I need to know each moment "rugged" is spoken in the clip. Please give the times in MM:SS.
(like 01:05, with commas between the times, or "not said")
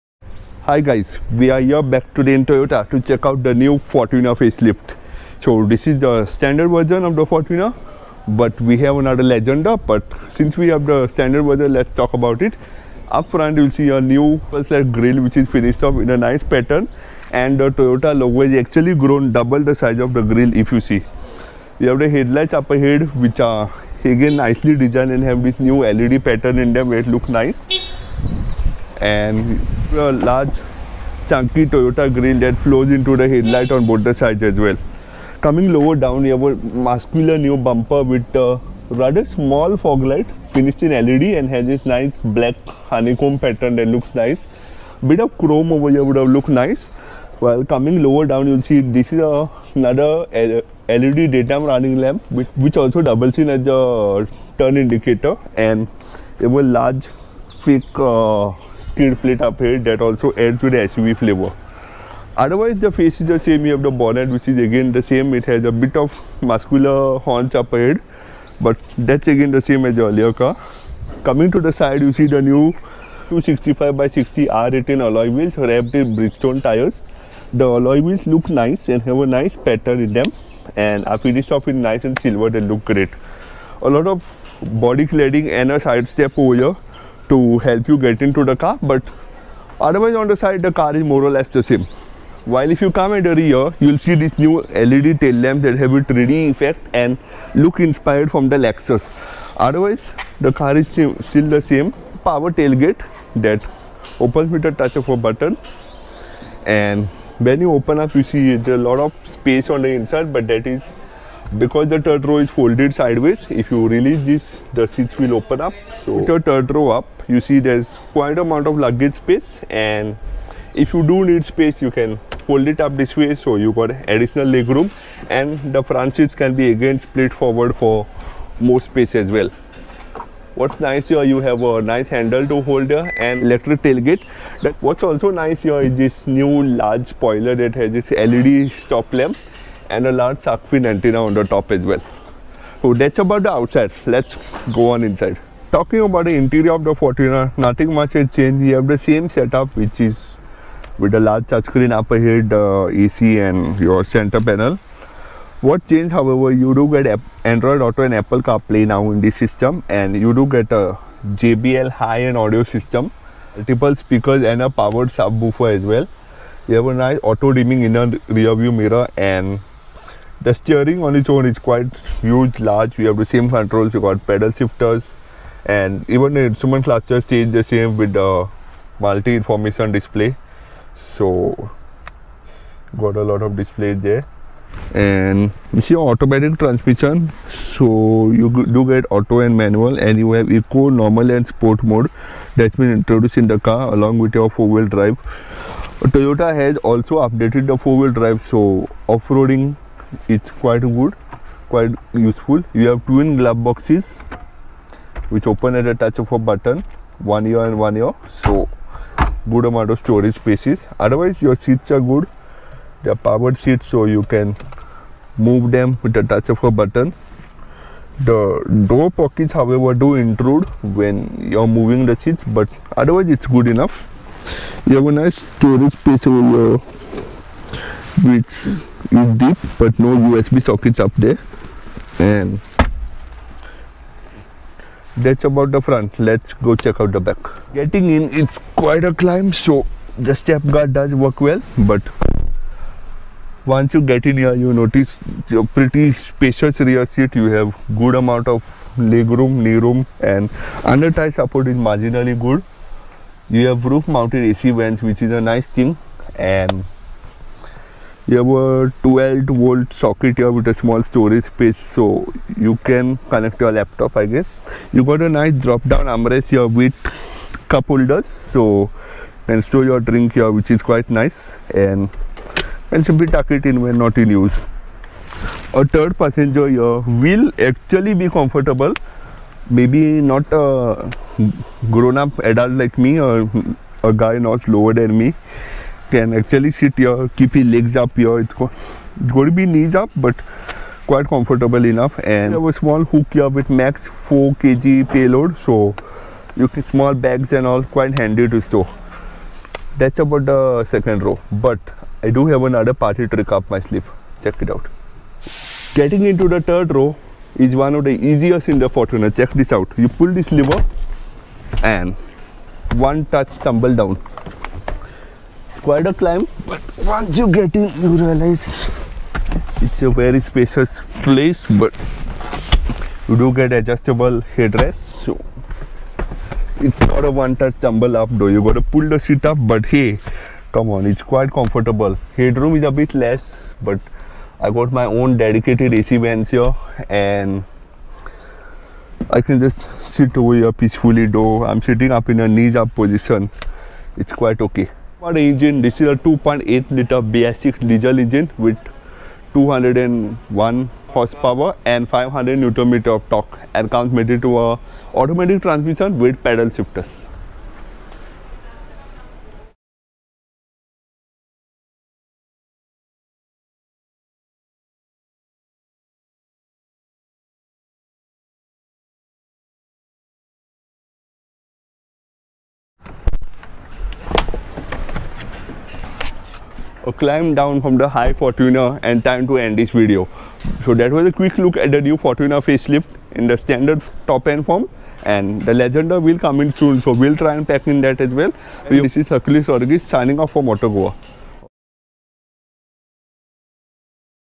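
not said.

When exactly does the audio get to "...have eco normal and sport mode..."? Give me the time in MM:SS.
03:10.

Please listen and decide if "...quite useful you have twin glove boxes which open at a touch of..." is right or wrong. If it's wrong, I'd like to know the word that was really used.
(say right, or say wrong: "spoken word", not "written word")
right.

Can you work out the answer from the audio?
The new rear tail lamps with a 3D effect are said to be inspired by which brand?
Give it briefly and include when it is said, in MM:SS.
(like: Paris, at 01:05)
Lexus, at 01:38.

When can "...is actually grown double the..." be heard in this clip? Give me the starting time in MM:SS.
00:18.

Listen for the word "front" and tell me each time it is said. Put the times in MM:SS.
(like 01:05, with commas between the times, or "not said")
00:13, 02:05, 03:55.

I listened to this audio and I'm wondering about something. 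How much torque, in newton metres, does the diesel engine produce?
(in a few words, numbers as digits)
500.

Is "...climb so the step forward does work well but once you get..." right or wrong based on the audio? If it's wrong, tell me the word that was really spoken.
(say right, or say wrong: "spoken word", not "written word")
wrong: "guard", not "forward".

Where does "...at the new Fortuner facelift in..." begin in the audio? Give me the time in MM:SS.
06:21.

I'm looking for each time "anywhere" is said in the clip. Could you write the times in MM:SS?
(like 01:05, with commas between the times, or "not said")
not said.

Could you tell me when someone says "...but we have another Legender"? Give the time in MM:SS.
00:08.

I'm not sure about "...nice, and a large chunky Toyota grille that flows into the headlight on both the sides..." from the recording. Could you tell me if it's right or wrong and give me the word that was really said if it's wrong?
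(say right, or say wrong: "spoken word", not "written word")
right.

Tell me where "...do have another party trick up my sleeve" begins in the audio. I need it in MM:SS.
05:02.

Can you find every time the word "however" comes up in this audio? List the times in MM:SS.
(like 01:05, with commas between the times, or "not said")
02:36, 03:39.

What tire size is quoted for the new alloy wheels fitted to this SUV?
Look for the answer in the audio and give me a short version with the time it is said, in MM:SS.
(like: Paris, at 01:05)
265/60 R18, at 01:13.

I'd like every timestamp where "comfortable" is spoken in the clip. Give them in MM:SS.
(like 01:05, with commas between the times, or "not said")
04:38, 04:51, 05:31.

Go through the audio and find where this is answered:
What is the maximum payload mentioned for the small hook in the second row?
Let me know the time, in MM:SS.
04:54.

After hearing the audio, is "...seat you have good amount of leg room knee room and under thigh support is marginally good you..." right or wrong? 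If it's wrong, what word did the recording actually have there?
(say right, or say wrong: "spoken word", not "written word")
right.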